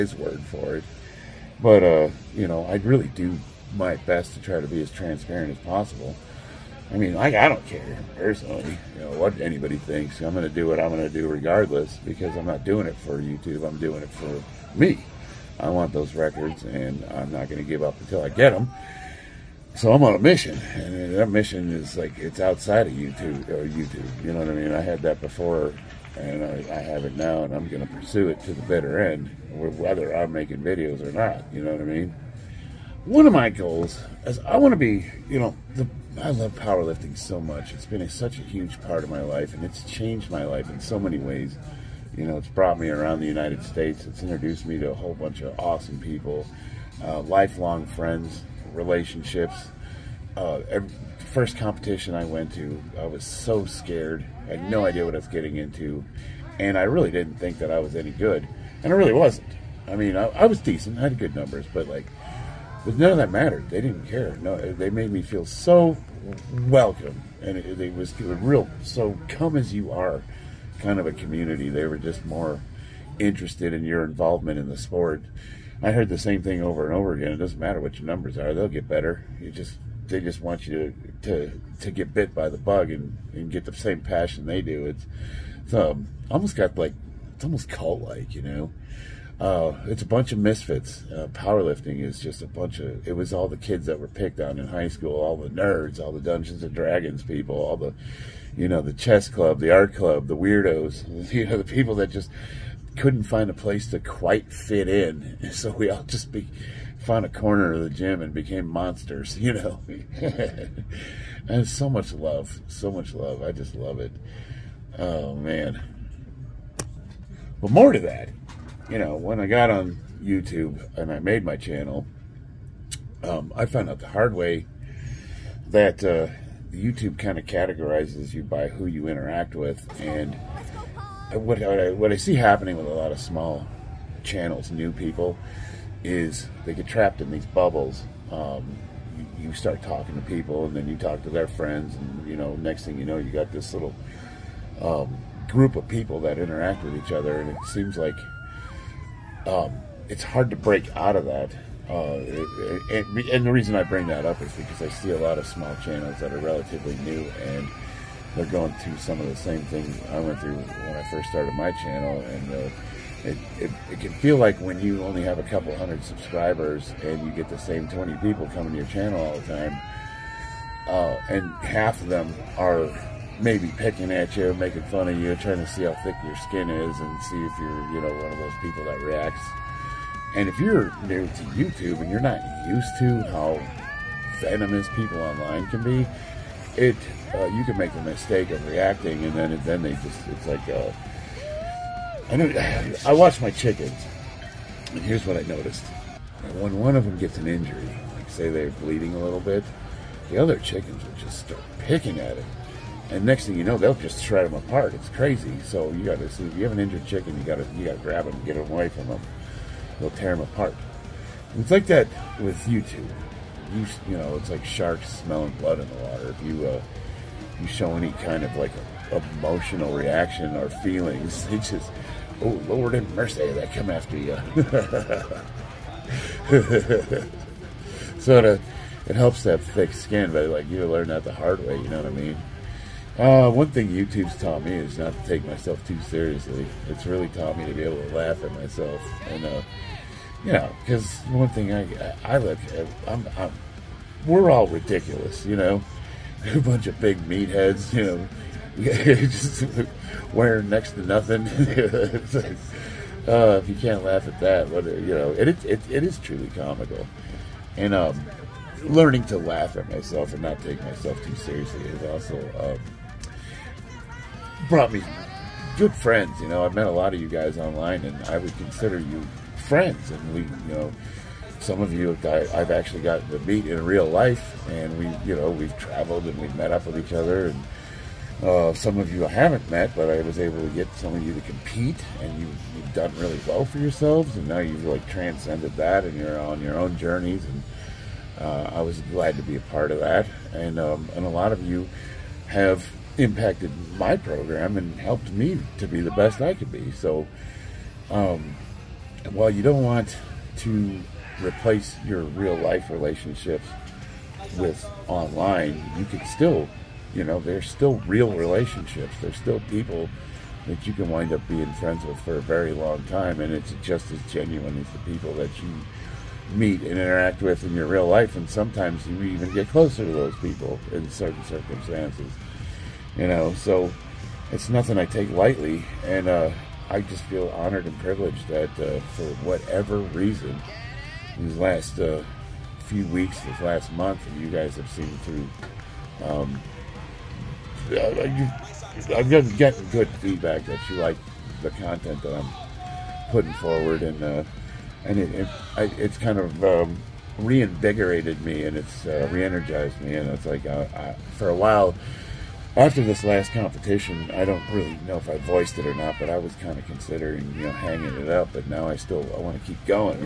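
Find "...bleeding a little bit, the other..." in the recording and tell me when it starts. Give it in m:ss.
3:18.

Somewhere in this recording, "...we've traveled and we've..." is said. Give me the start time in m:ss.
4:35.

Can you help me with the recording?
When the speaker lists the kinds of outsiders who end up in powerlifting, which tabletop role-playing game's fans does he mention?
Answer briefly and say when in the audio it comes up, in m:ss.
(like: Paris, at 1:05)
Dungeons and Dragons, at 1:36.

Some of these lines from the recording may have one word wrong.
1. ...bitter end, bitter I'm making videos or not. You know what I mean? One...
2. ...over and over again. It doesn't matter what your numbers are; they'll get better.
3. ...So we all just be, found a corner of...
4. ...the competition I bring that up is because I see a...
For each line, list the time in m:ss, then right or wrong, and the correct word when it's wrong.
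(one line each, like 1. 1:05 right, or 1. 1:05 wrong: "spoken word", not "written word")
1. 0:28 wrong: "whether", not "bitter"
2. 1:16 right
3. 1:45 right
4. 2:33 wrong: "reason", not "competition".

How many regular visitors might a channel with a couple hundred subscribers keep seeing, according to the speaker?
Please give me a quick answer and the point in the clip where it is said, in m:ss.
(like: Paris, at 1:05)
20, at 2:47.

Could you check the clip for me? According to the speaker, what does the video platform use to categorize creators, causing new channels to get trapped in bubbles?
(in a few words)
who you interact with.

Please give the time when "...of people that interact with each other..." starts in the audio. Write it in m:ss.
2:25.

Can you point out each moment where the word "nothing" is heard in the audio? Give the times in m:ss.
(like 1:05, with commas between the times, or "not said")
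4:11, 5:24.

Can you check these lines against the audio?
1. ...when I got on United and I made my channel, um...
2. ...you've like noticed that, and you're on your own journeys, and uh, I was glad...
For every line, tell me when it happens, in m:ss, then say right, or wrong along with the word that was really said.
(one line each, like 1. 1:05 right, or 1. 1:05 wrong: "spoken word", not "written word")
1. 1:59 wrong: "YouTube", not "United"
2. 4:44 wrong: "transcended", not "noticed".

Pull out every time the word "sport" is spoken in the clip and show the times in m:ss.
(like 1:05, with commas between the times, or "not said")
1:14.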